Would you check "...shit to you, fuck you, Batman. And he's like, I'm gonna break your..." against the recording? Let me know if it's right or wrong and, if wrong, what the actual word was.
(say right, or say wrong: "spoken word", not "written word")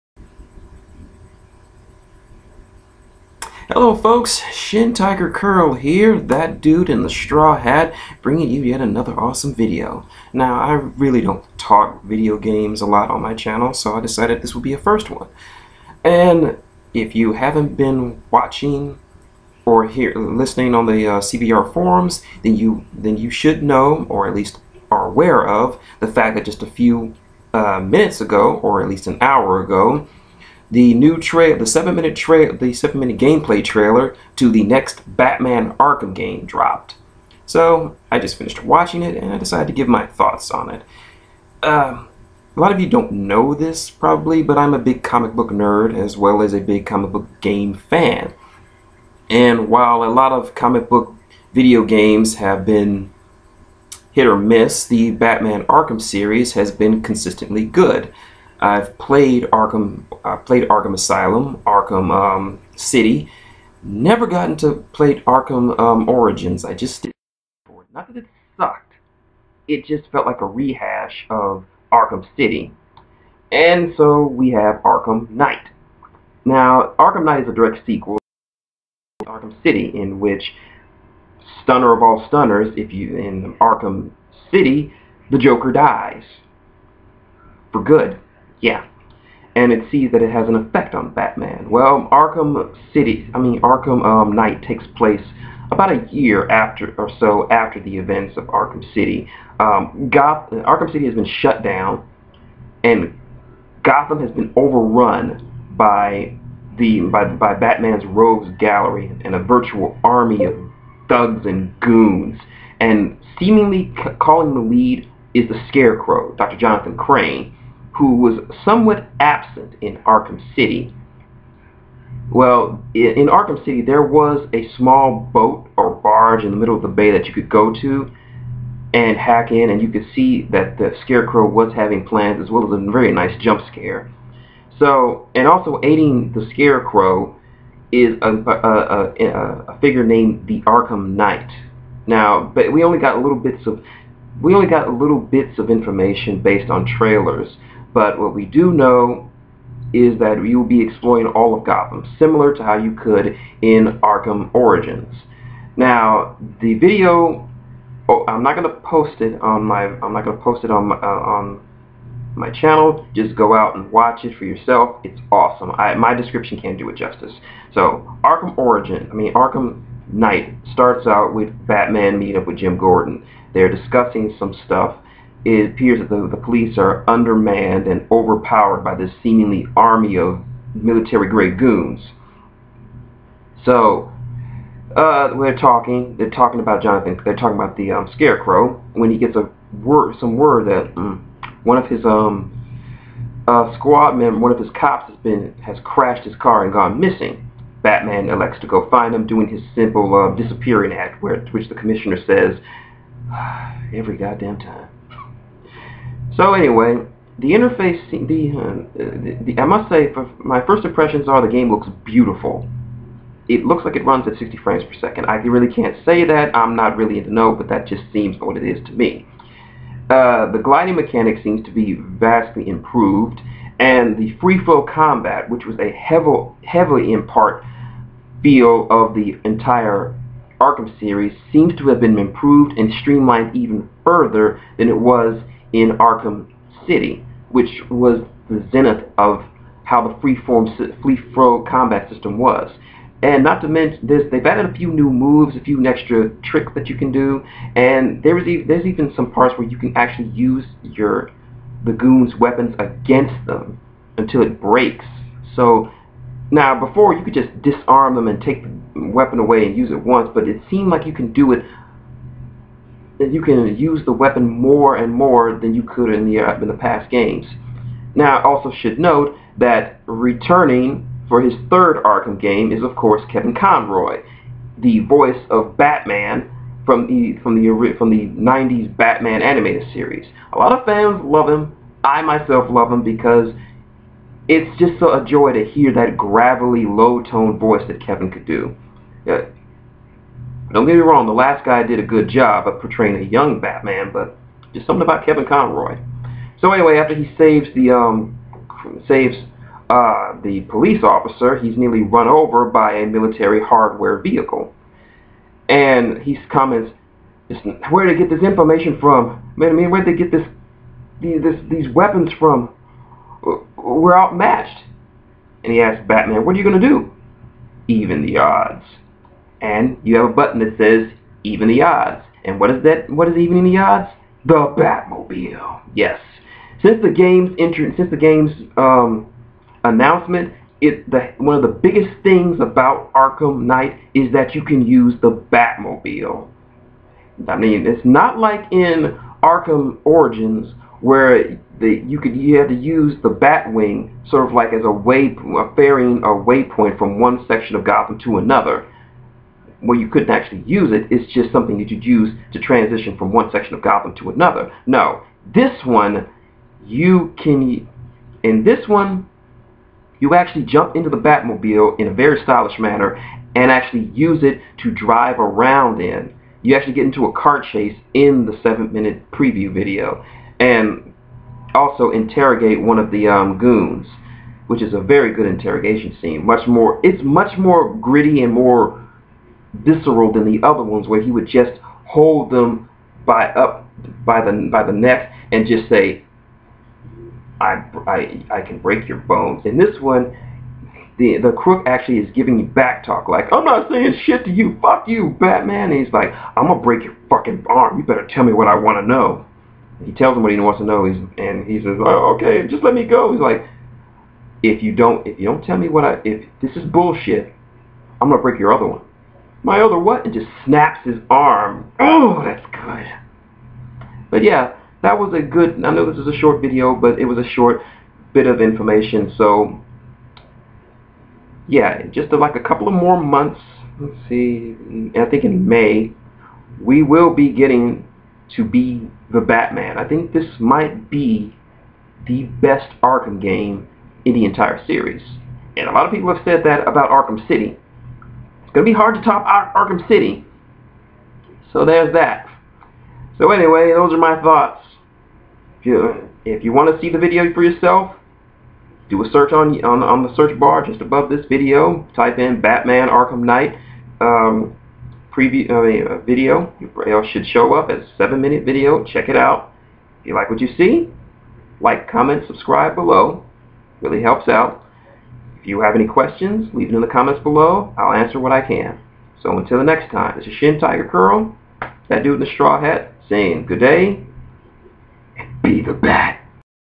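right.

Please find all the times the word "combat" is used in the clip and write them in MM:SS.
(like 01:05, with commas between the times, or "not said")
03:44, 04:01.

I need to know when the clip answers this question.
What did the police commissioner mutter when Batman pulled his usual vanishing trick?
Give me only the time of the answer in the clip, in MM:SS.
03:23.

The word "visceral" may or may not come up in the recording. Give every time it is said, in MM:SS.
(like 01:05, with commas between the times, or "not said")
06:19.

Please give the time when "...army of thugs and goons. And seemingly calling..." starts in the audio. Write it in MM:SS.
01:50.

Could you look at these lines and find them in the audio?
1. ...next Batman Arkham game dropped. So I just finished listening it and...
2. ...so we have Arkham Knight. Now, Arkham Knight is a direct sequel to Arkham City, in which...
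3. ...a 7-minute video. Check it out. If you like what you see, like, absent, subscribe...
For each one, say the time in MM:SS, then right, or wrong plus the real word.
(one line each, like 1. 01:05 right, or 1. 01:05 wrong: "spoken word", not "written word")
1. 00:34 wrong: "watching", not "listening"
2. 01:13 right
3. 07:38 wrong: "comment", not "absent".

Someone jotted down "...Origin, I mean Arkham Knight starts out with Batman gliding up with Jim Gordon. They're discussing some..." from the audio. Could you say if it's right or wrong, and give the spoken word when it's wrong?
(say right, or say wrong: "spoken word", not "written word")
wrong: "meeting", not "gliding".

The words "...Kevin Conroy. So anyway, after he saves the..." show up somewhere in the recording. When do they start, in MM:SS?
04:55.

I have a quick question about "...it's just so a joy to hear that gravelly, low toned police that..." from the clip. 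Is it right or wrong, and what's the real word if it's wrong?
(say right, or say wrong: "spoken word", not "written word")
wrong: "voice", not "police".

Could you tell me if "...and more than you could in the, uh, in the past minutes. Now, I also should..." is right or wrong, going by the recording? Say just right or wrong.
wrong.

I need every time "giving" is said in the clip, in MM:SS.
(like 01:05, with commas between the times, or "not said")
06:32.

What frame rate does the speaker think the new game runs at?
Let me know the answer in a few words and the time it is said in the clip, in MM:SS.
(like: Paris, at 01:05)
60 frames per second, at 03:34.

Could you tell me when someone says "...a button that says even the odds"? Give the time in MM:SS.
05:20.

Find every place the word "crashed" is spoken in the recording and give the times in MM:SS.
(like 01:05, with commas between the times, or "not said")
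03:15.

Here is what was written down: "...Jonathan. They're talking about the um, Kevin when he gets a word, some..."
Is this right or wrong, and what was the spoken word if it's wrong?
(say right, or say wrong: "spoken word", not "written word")
wrong: "Scarecrow", not "Kevin".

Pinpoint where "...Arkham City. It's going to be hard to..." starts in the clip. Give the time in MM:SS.
07:17.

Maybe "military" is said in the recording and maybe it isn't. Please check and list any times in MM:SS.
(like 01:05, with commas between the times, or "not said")
03:00, 05:03.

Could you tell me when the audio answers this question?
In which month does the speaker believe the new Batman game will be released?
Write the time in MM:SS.
07:05.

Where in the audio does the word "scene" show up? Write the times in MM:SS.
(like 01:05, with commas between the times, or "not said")
06:16.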